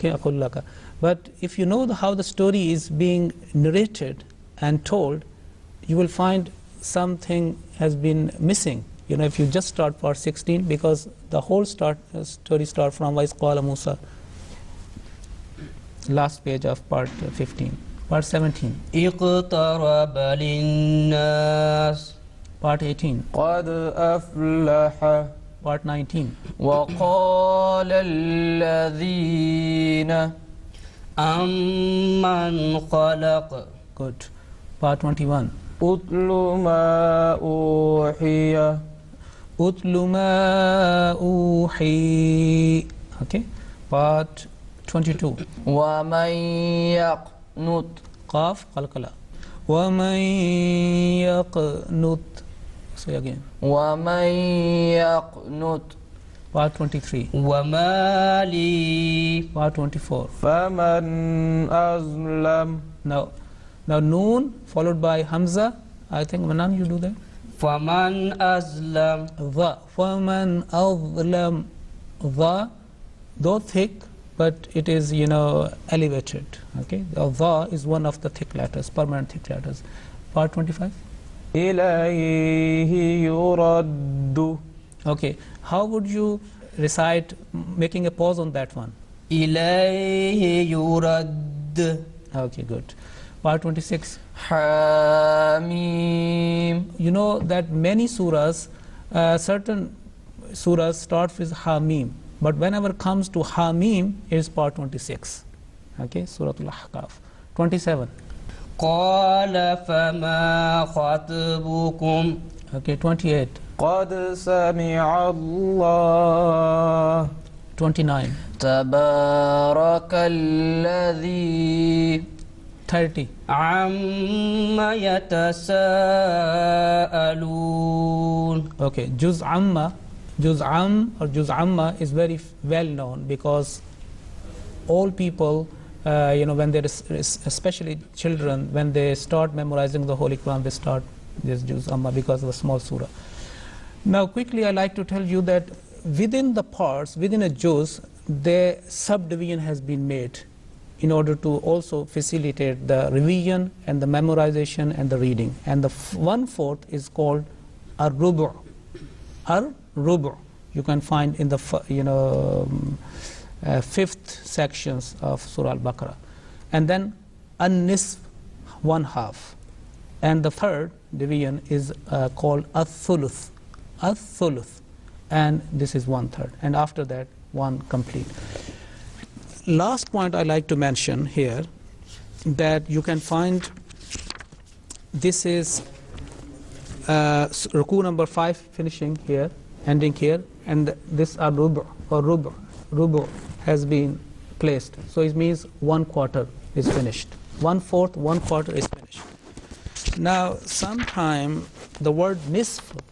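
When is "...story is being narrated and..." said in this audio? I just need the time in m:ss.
0:02.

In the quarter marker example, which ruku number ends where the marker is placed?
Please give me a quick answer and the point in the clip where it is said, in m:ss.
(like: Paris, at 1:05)
5, at 3:07.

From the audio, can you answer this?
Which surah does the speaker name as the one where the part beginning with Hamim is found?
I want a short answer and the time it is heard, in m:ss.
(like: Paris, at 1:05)
Surah Al-Ahqaf, at 1:46.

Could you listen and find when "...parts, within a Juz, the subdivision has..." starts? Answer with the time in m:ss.
2:26.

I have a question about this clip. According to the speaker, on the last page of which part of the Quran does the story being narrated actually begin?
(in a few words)
Part 15.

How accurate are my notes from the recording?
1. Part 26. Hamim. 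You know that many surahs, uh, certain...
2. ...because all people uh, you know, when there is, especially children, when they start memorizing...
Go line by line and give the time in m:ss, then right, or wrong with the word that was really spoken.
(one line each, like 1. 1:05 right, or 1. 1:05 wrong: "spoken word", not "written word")
1. 1:33 right
2. 2:13 right.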